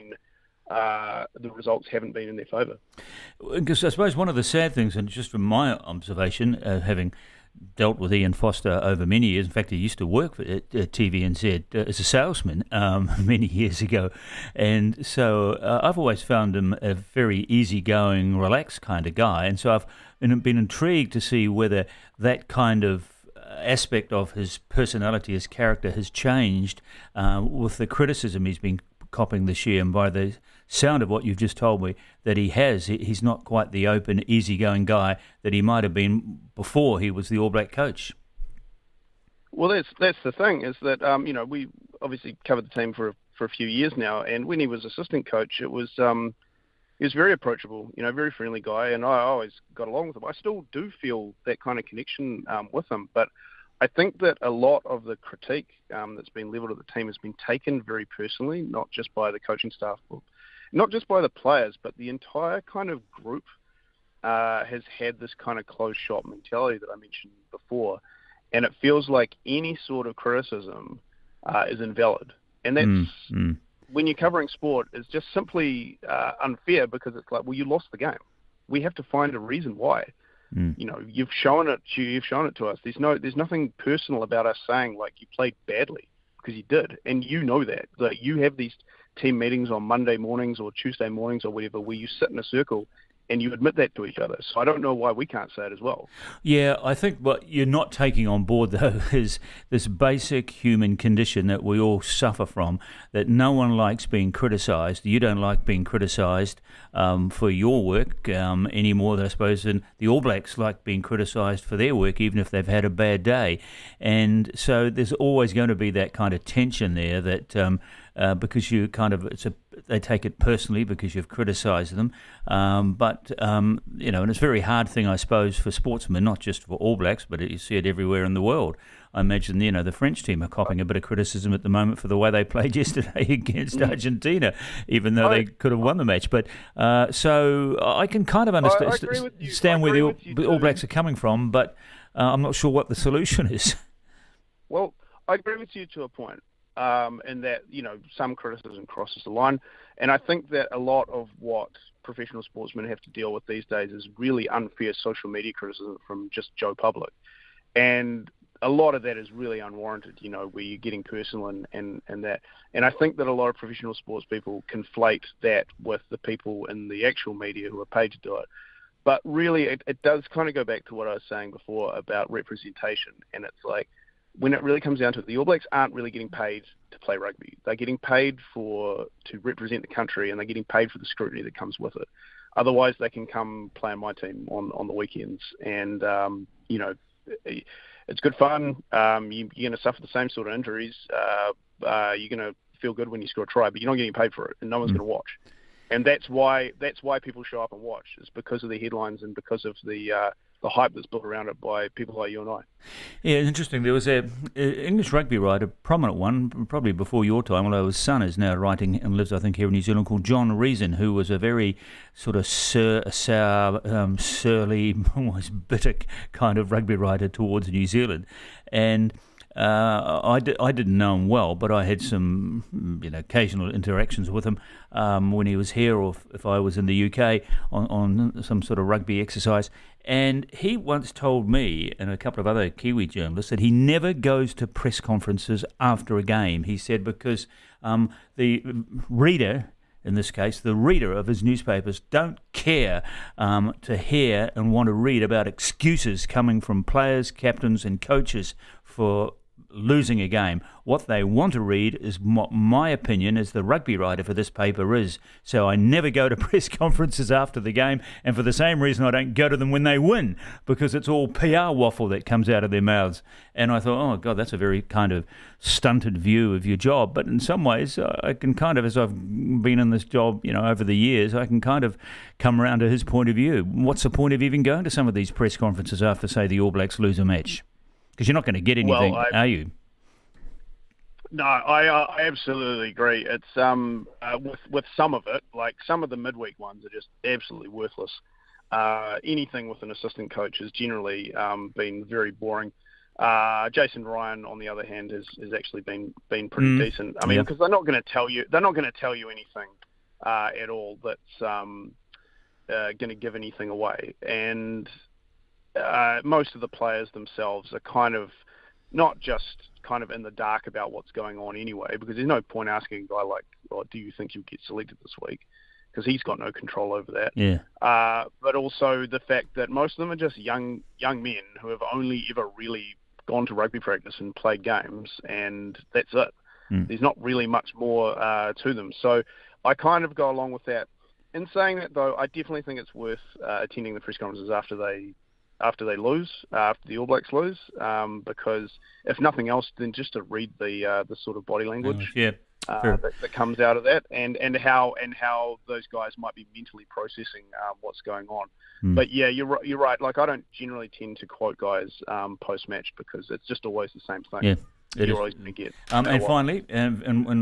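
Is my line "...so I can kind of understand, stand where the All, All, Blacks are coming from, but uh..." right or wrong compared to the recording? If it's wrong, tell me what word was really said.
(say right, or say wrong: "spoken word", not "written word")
right.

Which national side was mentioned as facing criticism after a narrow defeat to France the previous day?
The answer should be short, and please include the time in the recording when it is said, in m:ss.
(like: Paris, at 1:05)
Argentina, at 2:13.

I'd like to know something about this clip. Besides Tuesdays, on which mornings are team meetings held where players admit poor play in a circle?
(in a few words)
Monday.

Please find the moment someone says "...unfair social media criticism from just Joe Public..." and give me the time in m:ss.
2:34.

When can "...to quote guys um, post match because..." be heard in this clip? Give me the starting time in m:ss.
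5:51.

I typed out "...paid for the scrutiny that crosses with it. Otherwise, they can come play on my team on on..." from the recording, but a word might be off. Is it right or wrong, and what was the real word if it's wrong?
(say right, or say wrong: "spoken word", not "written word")
wrong: "comes", not "crosses".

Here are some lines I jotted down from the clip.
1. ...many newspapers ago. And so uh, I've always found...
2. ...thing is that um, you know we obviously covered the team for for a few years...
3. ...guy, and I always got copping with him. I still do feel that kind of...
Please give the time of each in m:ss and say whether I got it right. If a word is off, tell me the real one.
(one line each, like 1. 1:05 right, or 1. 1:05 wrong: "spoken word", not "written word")
1. 0:13 wrong: "years", not "newspapers"
2. 0:40 right
3. 0:48 wrong: "along", not "copping".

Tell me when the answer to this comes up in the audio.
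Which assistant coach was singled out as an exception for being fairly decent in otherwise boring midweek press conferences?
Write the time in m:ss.
4:53.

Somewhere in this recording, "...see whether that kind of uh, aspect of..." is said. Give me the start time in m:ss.
0:21.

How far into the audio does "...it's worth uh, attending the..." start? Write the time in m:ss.
5:32.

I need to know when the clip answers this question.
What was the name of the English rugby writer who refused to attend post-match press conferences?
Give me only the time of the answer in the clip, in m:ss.
3:30.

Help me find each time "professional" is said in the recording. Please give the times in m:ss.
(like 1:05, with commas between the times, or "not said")
2:32, 2:43.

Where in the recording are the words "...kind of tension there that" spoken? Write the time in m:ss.
1:56.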